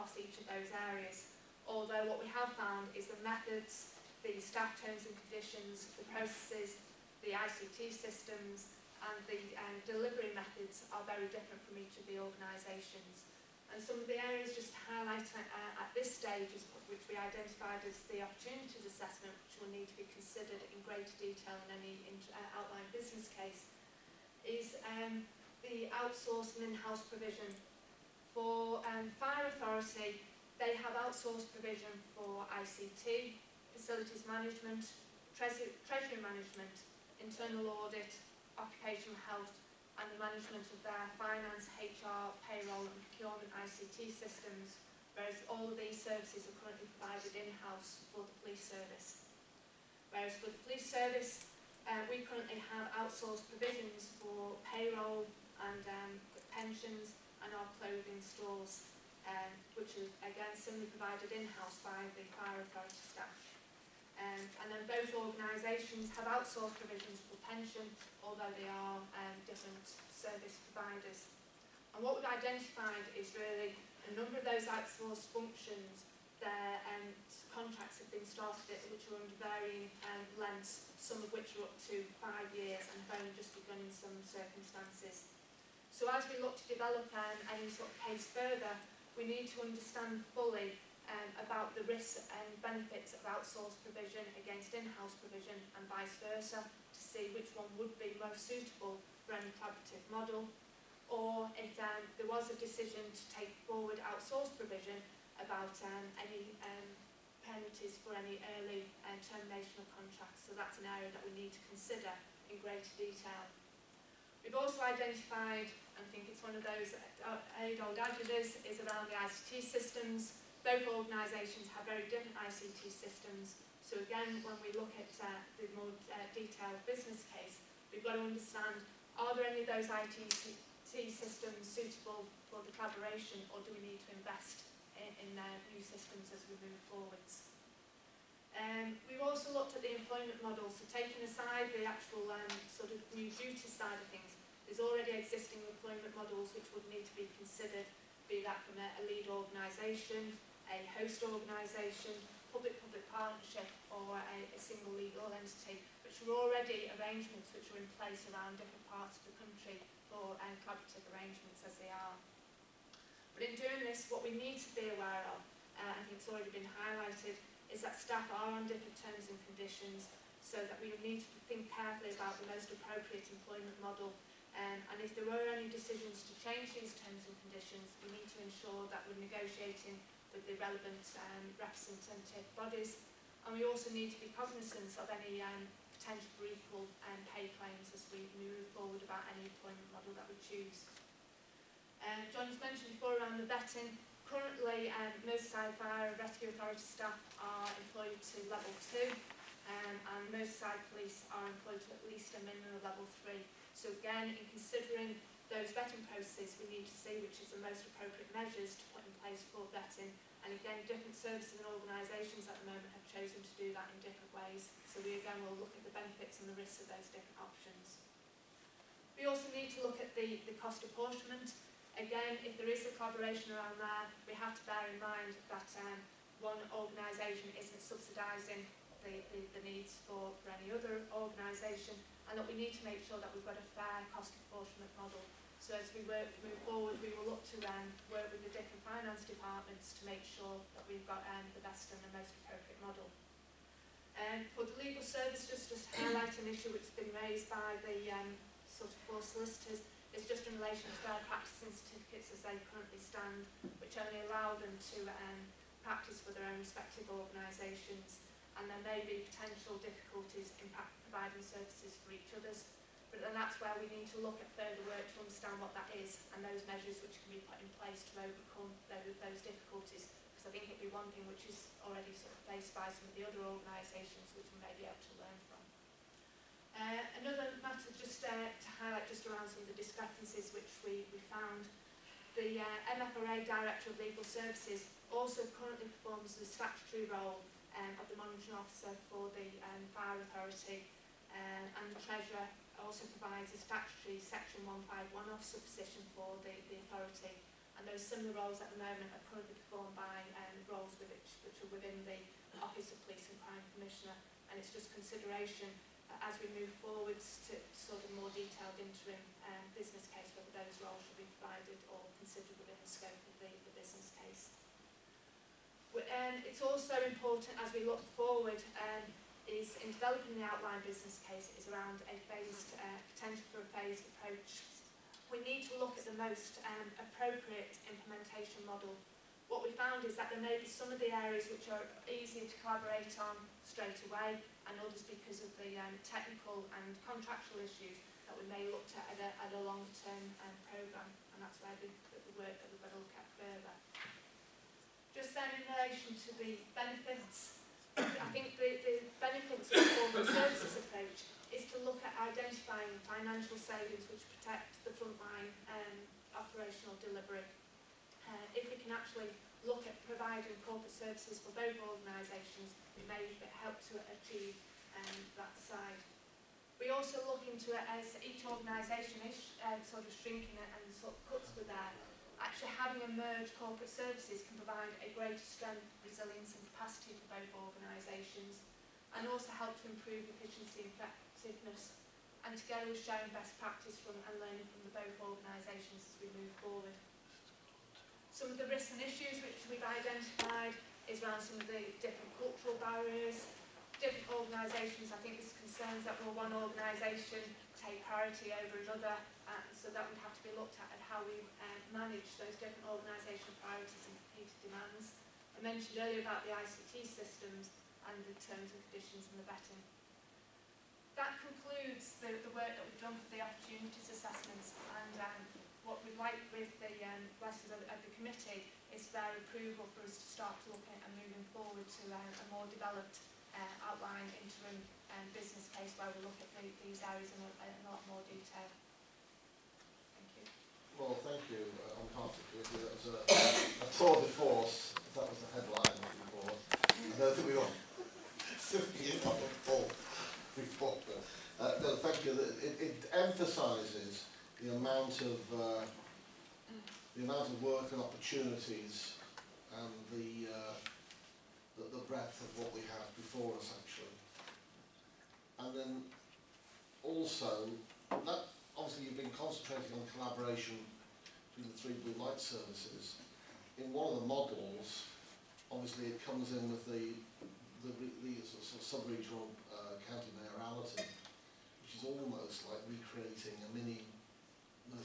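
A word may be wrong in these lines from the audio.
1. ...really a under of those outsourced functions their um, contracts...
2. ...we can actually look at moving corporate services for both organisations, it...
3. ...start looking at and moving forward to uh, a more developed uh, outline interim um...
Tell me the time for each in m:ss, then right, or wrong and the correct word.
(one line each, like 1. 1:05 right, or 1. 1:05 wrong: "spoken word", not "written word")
1. 1:13 wrong: "number", not "under"
2. 5:58 wrong: "providing", not "moving"
3. 7:00 right.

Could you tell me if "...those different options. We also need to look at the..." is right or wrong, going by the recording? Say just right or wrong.
right.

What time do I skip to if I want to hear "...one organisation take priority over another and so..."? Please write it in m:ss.
6:36.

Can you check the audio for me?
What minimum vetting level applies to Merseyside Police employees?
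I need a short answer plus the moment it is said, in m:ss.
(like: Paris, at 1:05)
Level 3, at 3:22.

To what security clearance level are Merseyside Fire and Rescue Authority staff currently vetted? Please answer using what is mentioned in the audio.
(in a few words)
Level 2.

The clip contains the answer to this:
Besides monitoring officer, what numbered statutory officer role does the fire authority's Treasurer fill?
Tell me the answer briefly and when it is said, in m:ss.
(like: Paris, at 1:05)
Section 151 officer, at 4:54.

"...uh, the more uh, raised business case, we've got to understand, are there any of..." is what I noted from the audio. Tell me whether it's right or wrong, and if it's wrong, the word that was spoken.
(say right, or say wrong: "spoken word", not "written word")
wrong: "detailed", not "raised".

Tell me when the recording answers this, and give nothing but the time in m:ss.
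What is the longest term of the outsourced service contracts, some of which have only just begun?
1:22.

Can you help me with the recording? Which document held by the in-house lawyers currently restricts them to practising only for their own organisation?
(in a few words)
Practicing certificates.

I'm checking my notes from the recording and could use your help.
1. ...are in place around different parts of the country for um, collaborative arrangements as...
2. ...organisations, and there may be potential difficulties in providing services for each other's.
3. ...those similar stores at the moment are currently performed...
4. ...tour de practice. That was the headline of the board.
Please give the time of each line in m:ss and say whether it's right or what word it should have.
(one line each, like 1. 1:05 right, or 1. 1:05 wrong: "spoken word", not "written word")
1. 2:37 right
2. 4:17 right
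3. 4:57 wrong: "roles", not "stores"
4. 7:13 wrong: "force", not "practice".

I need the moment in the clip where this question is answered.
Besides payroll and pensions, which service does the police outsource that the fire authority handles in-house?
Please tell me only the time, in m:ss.
0:57.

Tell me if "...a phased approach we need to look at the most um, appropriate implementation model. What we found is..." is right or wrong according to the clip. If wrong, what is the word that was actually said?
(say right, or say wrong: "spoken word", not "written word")
right.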